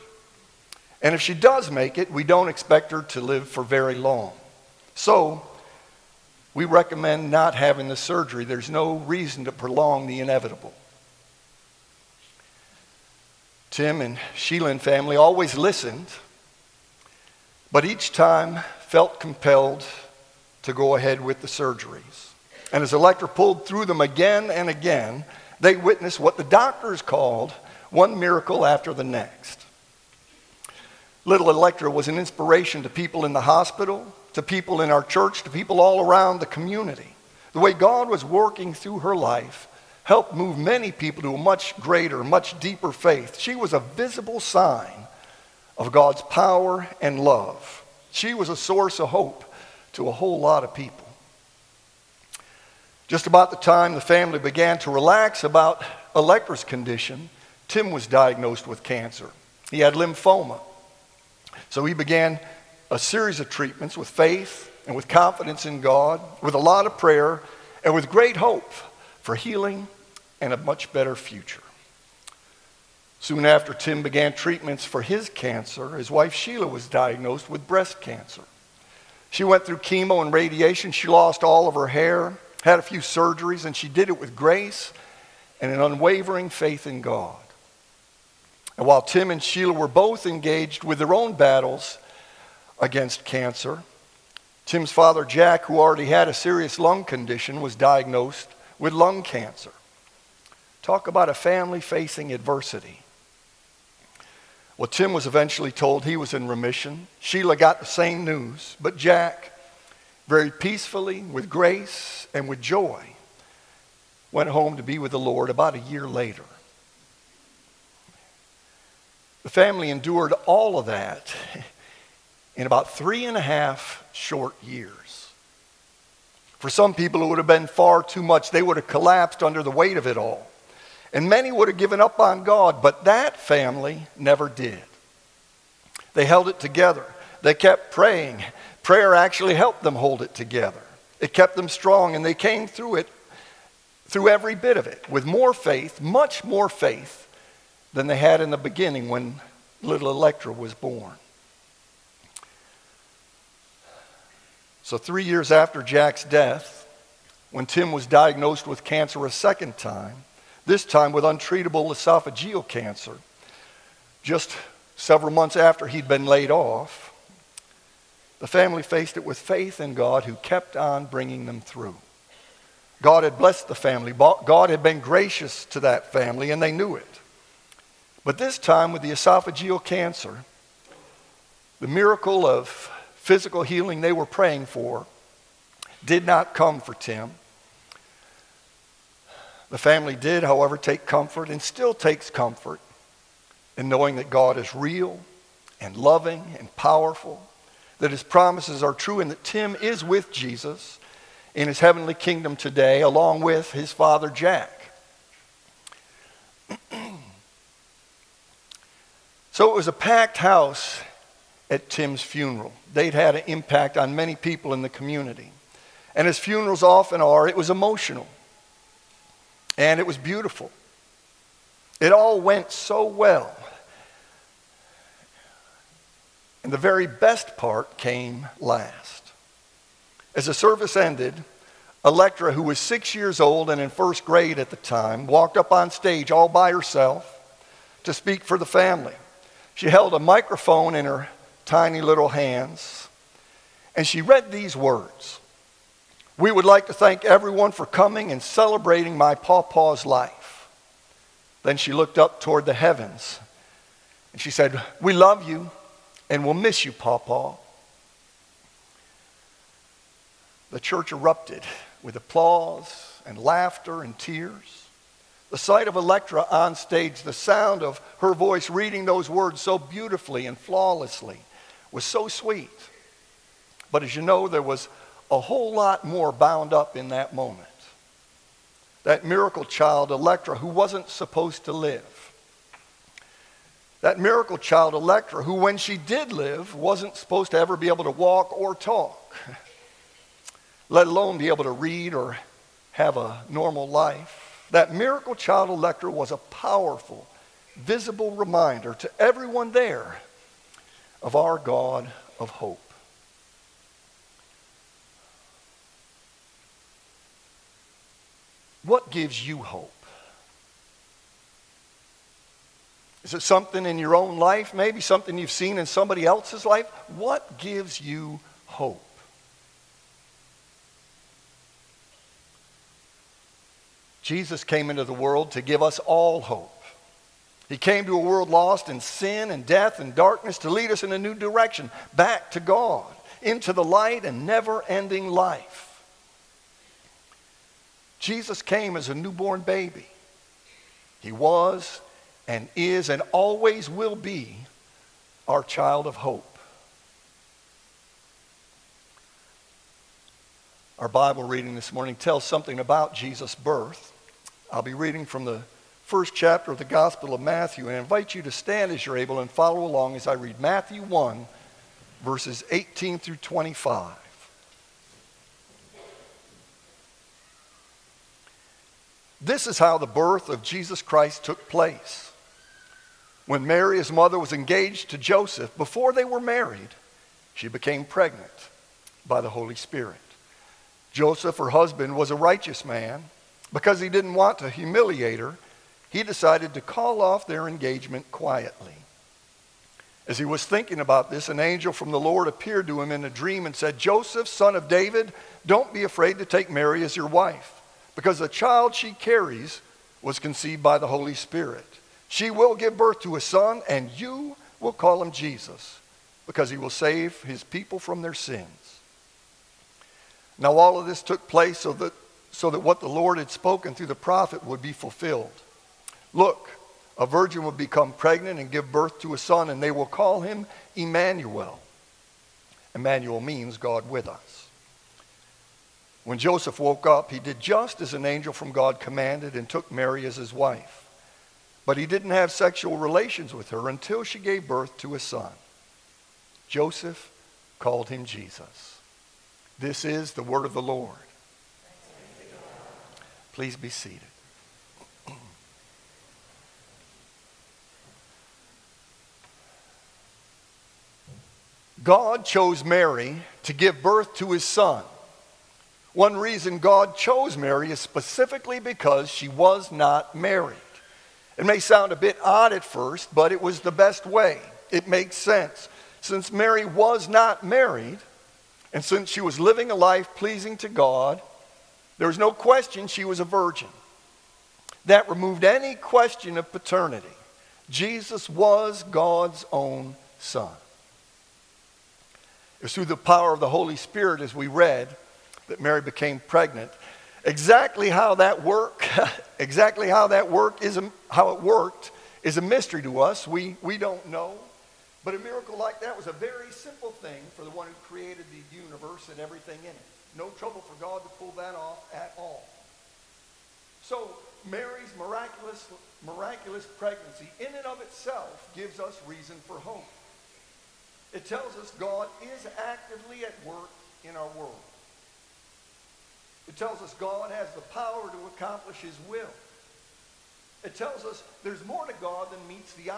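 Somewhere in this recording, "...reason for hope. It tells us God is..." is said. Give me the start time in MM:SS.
08:29.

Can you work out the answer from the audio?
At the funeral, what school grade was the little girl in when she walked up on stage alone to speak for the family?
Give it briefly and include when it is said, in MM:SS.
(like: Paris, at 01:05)
First grade, at 03:53.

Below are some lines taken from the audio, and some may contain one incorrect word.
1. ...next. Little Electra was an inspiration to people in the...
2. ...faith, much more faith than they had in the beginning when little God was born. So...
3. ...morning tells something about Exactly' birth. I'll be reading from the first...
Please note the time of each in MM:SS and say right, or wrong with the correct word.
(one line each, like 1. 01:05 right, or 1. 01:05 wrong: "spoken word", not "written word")
1. 00:29 right
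2. 02:25 wrong: "Electra", not "God"
3. 05:51 wrong: "Jesus", not "Exactly".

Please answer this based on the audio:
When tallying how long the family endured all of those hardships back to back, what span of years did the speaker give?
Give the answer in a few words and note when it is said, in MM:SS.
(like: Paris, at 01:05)
3.5 years, at 02:02.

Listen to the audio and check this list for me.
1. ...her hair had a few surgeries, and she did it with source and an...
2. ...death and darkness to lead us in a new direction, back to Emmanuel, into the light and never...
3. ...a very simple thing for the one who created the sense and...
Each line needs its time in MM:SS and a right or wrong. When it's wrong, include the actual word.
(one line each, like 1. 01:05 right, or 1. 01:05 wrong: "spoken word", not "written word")
1. 01:21 wrong: "grace", not "source"
2. 05:29 wrong: "God", not "Emmanuel"
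3. 08:16 wrong: "universe", not "sense".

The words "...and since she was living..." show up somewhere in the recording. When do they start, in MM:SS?
07:48.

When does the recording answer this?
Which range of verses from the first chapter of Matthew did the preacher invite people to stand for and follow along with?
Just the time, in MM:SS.
06:02.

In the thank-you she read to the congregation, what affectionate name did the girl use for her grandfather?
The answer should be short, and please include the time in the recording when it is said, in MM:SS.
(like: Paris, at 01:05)
Pawpaw, at 04:09.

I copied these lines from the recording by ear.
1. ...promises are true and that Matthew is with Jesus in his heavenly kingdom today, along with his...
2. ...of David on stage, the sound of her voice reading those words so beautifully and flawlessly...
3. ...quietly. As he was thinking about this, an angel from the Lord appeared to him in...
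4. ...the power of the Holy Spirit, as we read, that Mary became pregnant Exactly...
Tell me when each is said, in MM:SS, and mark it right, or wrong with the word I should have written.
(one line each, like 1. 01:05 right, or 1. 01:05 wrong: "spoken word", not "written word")
1. 03:18 wrong: "Tim", not "Matthew"
2. 04:25 wrong: "Electra", not "David"
3. 06:28 right
4. 08:03 right.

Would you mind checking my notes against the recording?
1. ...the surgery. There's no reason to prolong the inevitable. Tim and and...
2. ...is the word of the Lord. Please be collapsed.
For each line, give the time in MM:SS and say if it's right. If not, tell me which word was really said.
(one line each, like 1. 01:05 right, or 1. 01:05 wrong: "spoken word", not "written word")
1. 00:07 right
2. 07:20 wrong: "seated", not "collapsed".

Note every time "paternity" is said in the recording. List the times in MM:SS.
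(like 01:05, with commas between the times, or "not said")
07:56.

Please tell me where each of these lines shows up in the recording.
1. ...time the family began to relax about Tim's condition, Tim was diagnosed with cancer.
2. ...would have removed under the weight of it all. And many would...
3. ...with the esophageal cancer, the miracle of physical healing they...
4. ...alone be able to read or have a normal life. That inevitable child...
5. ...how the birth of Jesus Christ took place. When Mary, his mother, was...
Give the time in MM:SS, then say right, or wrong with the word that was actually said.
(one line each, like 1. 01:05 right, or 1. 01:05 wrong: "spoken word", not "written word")
1. 00:53 wrong: "Electra", not "Tim"
2. 02:08 wrong: "collapsed", not "removed"
3. 02:58 right
4. 04:51 wrong: "miracle", not "inevitable"
5. 06:09 right.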